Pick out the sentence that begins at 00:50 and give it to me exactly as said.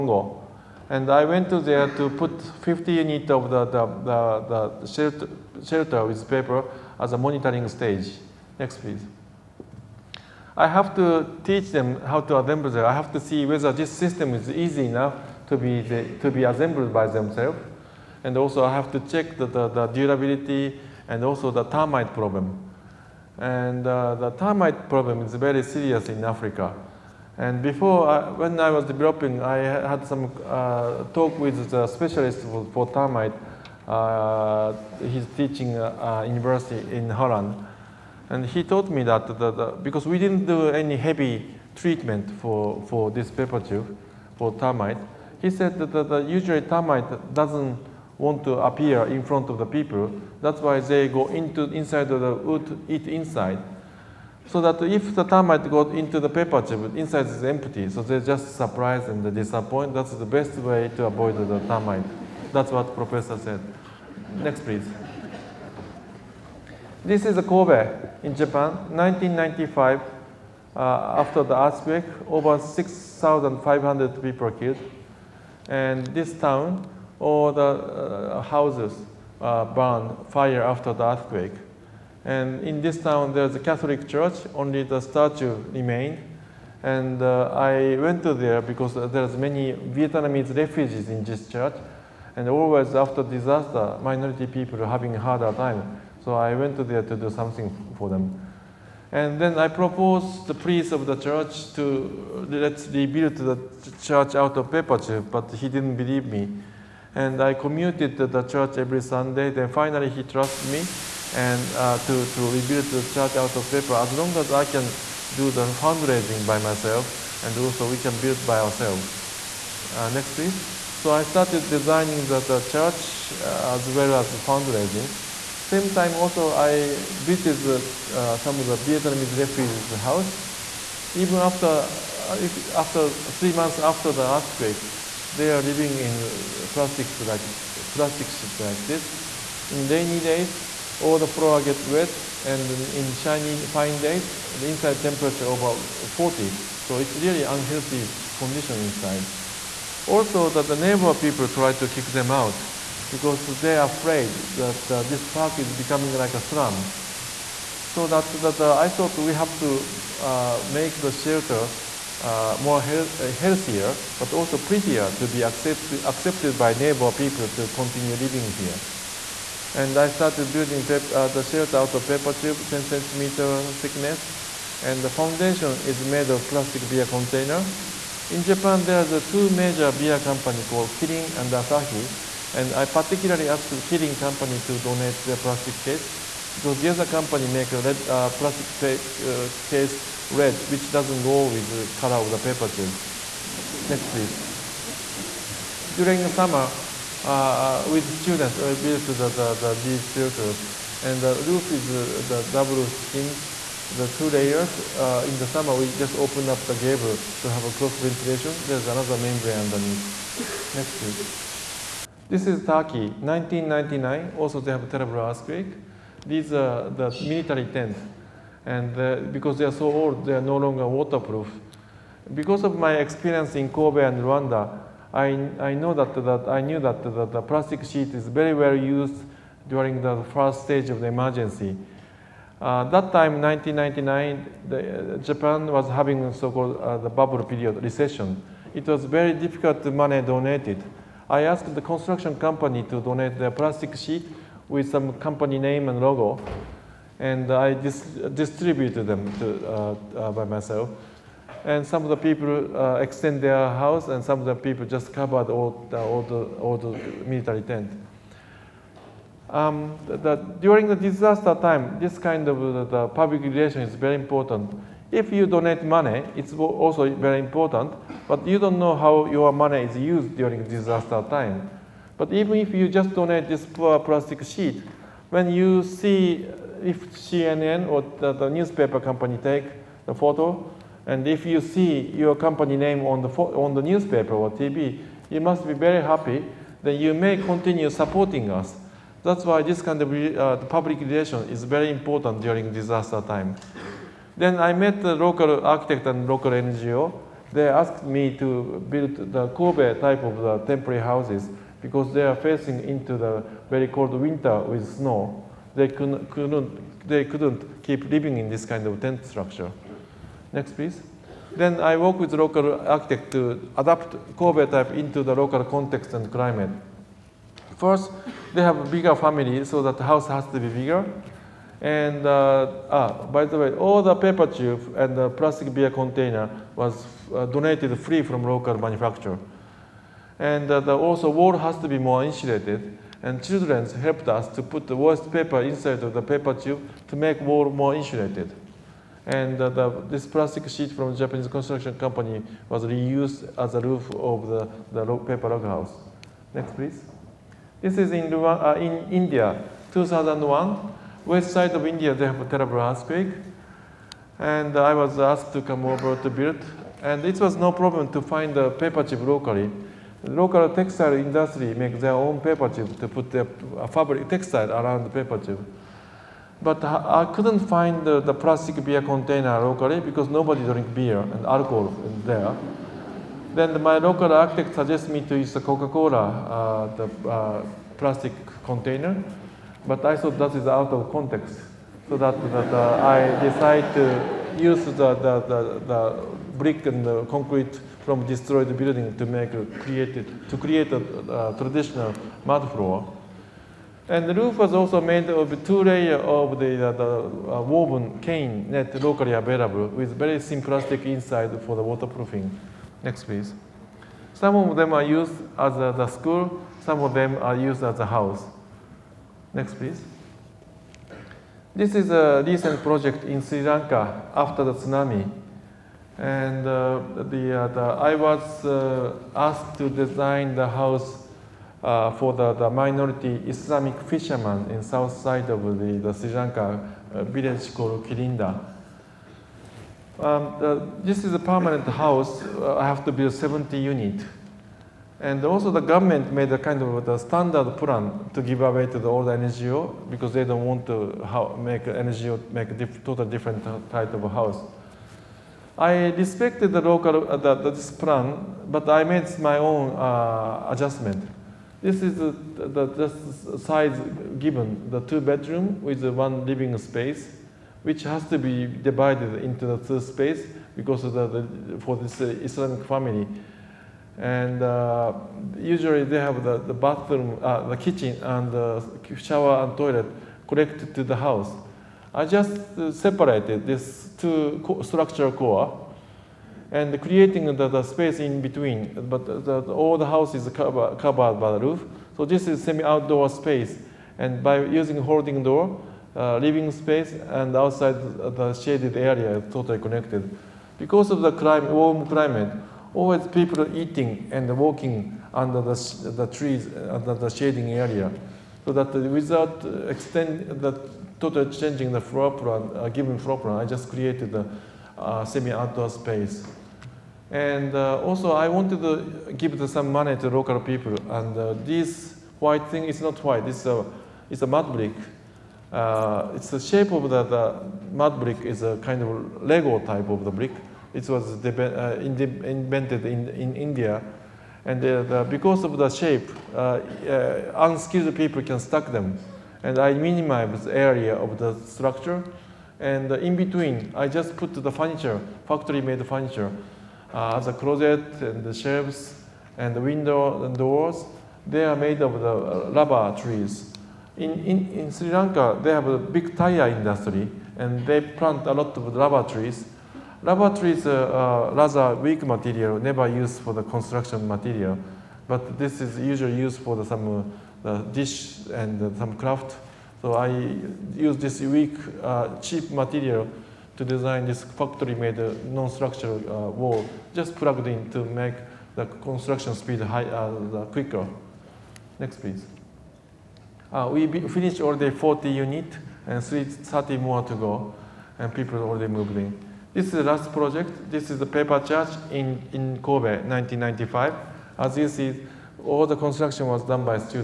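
That's why they go into inside of the wood, eat inside.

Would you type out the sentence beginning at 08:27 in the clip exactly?
And uh, also I wanted to give some money to local people.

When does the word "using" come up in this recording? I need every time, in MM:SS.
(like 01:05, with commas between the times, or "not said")
08:04.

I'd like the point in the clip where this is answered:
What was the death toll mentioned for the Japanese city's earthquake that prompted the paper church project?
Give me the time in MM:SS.
01:12.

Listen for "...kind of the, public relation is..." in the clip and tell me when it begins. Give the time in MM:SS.
04:22.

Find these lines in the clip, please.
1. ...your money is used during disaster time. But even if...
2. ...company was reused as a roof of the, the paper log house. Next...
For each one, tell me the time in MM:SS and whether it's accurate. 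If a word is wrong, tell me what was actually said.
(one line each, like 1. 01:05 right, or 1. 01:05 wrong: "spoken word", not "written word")
1. 04:29 right
2. 05:41 right.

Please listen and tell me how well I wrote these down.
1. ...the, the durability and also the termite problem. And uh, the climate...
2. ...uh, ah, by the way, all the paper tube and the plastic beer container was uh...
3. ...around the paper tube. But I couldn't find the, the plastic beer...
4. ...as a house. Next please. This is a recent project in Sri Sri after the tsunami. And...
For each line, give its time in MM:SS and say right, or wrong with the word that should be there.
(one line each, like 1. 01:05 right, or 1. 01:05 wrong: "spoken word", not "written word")
1. 00:19 wrong: "termite", not "climate"
2. 05:22 right
3. 06:04 right
4. 06:47 wrong: "Lanka", not "Sri".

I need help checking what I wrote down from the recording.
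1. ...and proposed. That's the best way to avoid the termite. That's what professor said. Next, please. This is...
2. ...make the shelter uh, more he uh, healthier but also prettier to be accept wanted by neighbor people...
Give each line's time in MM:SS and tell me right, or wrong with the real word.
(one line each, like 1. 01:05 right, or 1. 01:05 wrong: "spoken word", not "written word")
1. 00:59 wrong: "disappointed", not "proposed"
2. 02:40 wrong: "accepted", not "wanted".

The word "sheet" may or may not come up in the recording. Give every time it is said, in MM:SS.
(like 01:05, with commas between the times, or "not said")
03:47, 04:03, 04:34, 05:40.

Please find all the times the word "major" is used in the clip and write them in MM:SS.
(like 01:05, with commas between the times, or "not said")
02:59.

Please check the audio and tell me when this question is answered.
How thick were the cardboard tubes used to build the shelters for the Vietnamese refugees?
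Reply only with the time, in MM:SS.
02:52.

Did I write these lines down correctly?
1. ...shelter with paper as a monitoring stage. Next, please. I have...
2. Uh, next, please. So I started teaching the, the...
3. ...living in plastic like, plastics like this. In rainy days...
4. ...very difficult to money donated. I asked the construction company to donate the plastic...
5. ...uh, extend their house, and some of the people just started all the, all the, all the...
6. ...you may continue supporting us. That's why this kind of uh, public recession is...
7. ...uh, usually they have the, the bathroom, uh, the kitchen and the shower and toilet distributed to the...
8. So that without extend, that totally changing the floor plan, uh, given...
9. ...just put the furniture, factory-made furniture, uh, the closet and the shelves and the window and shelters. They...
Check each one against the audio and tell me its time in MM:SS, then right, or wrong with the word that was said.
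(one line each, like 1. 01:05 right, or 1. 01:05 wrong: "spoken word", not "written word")
1. 00:05 right
2. 01:59 wrong: "designing", not "teaching"
3. 02:15 right
4. 03:59 right
5. 04:12 wrong: "covered", not "started"
6. 04:47 wrong: "relation", not "recession"
7. 07:44 wrong: "connected", not "distributed"
8. 08:18 right
9. 08:54 wrong: "doors", not "shelters".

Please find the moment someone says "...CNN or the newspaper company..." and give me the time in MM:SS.
04:37.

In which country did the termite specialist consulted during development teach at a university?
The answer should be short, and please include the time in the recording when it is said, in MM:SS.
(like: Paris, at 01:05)
Holland, at 00:37.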